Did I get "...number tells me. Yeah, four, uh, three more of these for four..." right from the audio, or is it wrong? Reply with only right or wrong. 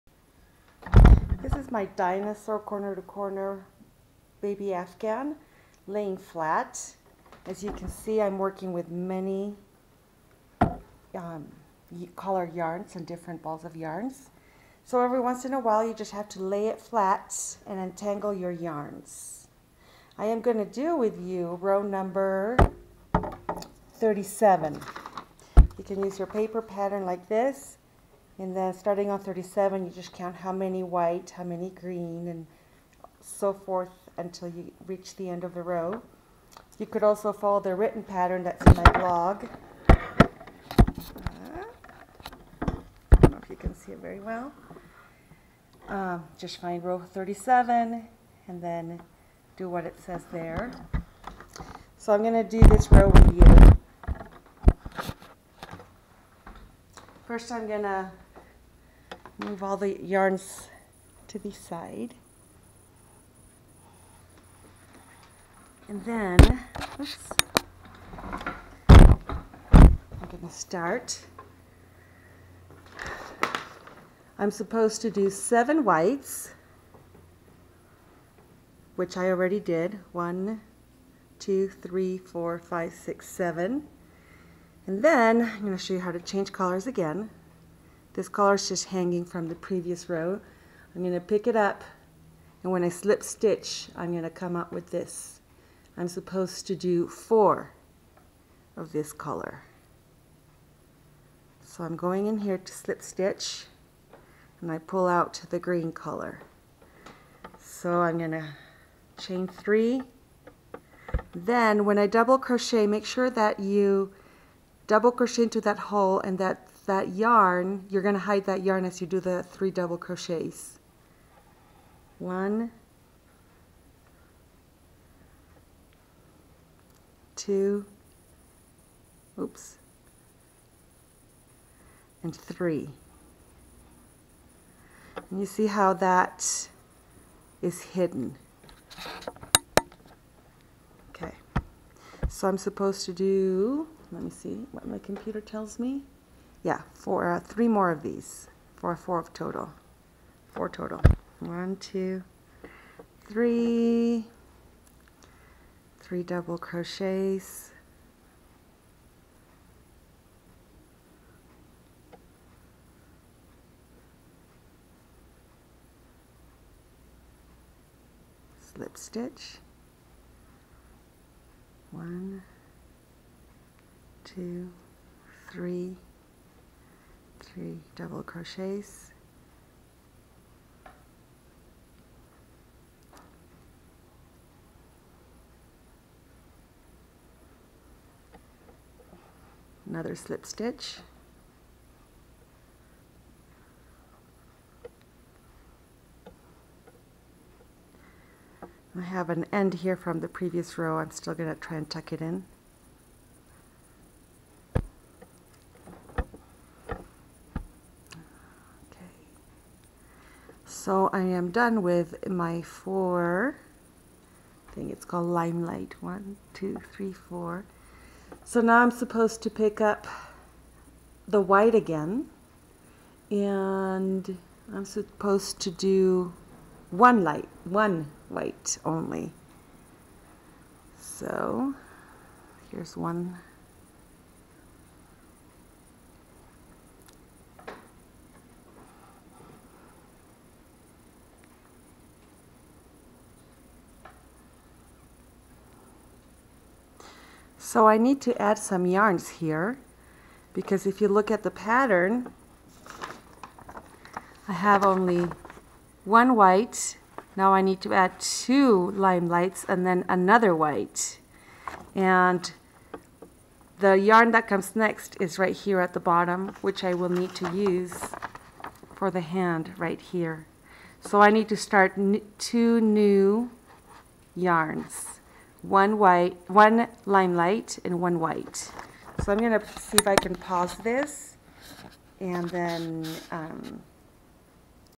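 wrong.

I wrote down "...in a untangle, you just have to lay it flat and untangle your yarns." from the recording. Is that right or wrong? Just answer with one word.
wrong.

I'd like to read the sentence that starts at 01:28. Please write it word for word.
This color is just hanging from the previous row.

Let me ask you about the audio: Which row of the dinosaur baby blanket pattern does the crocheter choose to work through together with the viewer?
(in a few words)
Row 37.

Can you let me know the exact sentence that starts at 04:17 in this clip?
Now I need to add two limelights and then another white.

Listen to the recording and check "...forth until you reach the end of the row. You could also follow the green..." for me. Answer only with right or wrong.
wrong.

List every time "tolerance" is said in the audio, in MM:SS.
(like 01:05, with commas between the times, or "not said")
not said.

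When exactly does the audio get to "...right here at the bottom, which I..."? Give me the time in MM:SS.
04:25.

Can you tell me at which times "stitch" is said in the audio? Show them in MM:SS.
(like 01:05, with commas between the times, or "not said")
01:33, 01:43, 02:48, 03:10.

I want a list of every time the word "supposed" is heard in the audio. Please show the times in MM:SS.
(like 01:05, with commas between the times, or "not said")
01:14, 01:36, 02:22, 03:38, 03:44.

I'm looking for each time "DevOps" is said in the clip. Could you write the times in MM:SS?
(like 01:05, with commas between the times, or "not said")
not said.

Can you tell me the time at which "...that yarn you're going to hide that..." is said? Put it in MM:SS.
01:56.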